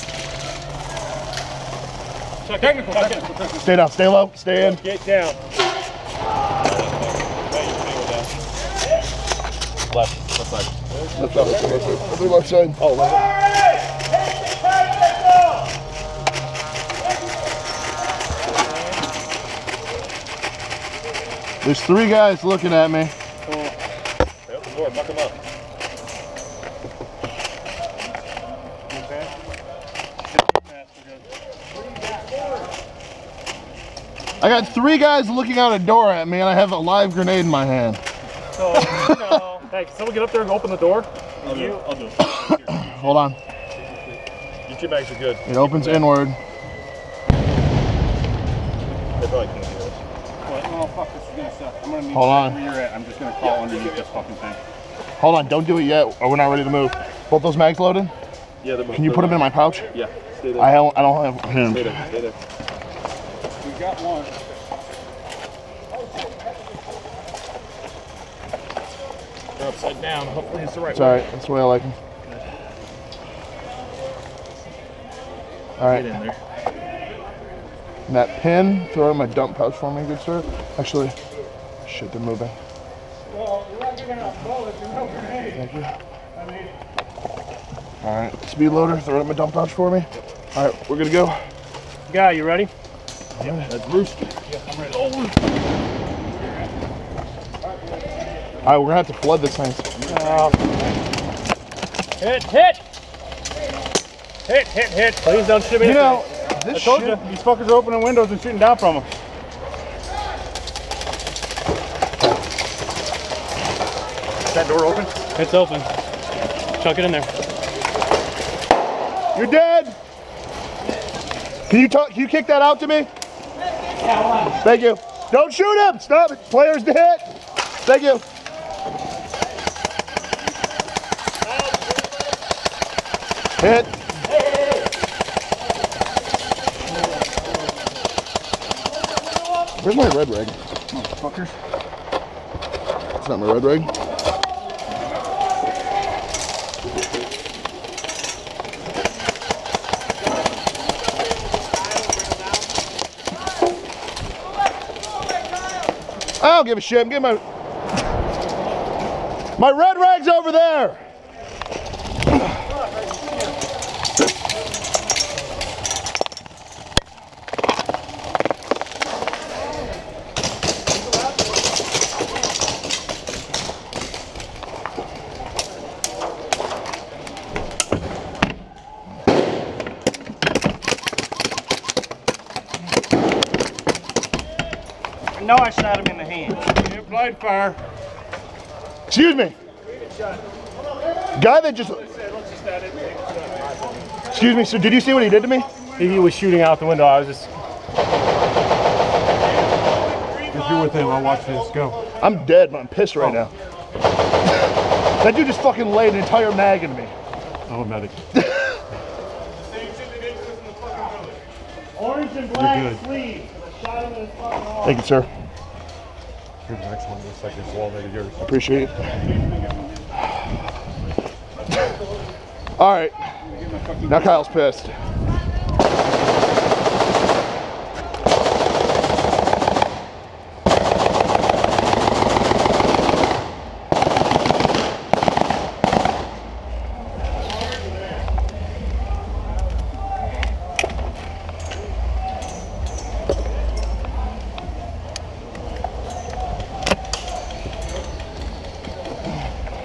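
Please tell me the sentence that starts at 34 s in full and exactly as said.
got three guys looking out a door at me, and I have a live grenade in my hand.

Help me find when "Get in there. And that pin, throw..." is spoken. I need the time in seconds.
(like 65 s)
76 s.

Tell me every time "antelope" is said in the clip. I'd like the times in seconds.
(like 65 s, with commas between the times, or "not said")
not said.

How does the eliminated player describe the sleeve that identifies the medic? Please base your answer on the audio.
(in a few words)
orange and black.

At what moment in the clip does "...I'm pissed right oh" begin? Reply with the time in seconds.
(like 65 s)
202 s.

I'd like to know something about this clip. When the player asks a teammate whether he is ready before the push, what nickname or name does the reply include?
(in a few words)
Rooster.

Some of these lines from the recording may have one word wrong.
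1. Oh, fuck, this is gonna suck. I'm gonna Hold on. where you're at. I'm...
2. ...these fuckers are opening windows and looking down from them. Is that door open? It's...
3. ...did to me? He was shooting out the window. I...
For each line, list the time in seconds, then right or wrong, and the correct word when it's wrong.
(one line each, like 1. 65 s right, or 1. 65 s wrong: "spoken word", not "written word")
1. 50 s right
2. 107 s wrong: "shooting", not "looking"
3. 195 s right.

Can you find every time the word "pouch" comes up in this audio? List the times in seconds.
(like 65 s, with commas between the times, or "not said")
59 s, 79 s, 89 s.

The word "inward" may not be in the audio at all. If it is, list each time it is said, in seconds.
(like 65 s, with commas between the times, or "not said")
45 s.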